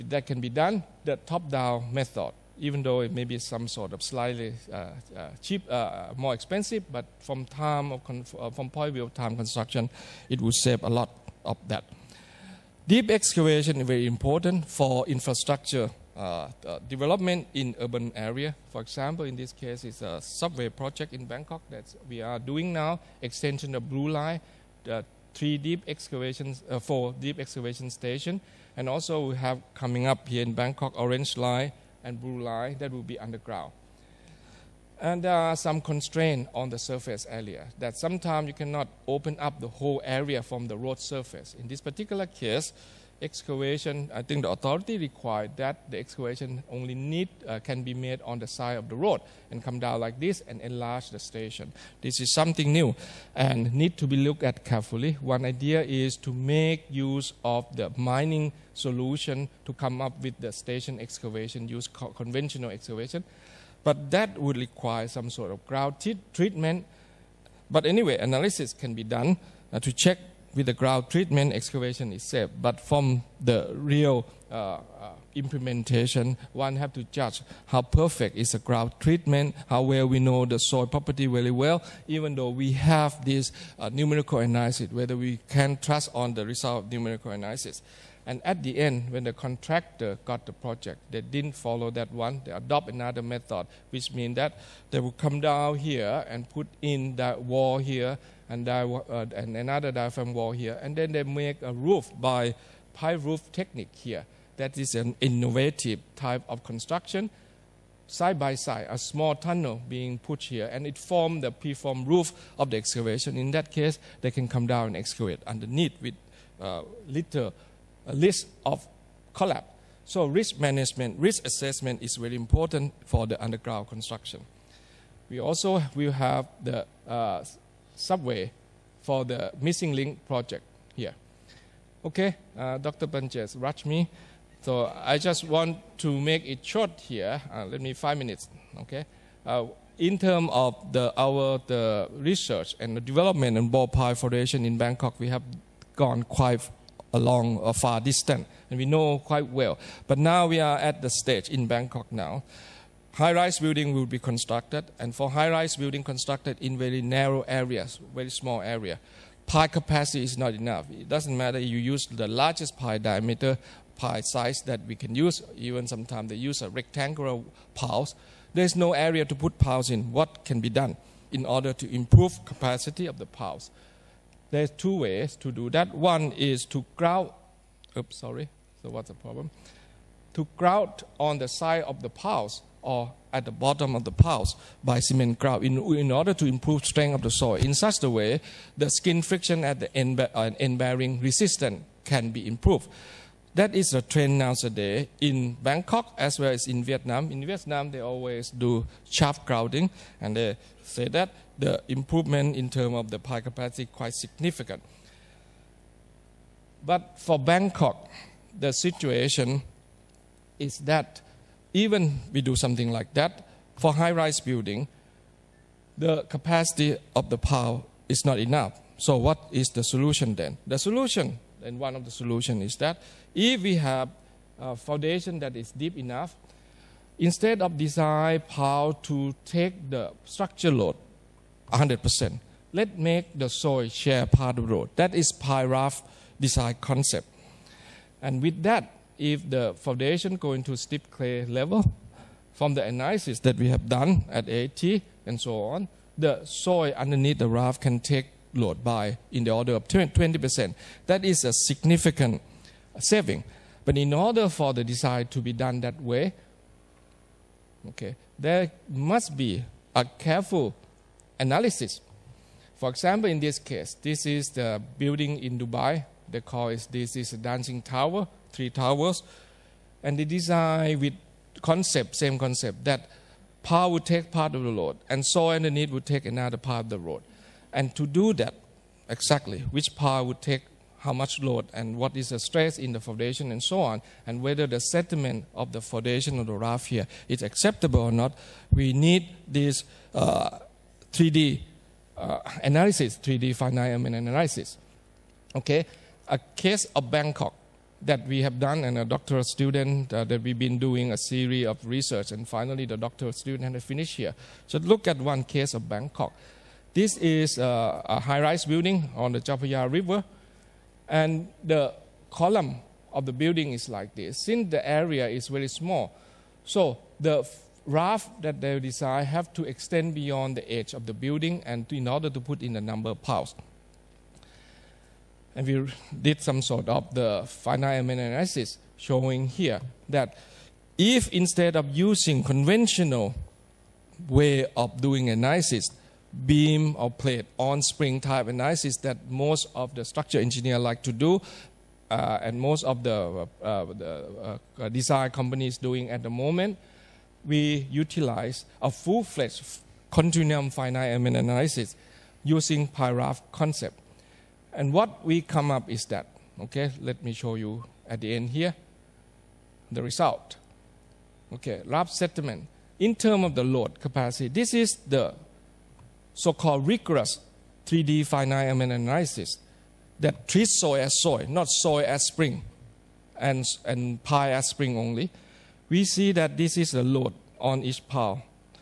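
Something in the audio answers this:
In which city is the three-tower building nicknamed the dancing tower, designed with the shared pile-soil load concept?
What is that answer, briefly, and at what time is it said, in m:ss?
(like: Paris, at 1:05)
Dubai, at 4:25.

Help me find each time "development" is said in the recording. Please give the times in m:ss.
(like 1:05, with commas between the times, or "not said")
0:16, 2:23.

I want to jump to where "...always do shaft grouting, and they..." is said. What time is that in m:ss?
3:17.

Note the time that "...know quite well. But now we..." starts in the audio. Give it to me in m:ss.
2:28.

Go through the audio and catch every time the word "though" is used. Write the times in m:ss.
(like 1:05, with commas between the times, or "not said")
0:02, 1:22.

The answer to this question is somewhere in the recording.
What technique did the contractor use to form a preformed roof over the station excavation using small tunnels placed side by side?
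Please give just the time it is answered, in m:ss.
1:42.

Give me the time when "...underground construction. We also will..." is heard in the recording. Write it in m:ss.
2:03.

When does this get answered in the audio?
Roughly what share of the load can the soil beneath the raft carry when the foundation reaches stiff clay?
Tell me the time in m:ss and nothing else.
4:09.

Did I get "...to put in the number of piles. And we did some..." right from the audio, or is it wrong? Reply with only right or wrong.
right.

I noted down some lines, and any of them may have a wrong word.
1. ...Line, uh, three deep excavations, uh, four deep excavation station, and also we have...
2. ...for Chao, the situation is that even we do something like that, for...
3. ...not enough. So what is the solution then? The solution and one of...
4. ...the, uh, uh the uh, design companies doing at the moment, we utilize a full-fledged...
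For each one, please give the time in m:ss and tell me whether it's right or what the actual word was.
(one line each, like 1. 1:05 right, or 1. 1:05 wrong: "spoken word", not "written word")
1. 0:24 right
2. 3:27 wrong: "Bangkok", not "Chao"
3. 3:38 right
4. 5:43 right.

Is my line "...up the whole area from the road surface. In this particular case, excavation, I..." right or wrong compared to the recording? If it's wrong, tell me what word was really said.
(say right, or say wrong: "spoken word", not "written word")
right.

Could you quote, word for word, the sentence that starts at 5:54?
And what we come up is that, okay, let me show you at the end here, the result.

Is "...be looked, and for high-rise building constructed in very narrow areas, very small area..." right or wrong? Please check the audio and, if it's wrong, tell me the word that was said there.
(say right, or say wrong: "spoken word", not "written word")
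wrong: "constructed", not "looked".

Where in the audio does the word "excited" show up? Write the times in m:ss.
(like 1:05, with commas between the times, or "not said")
not said.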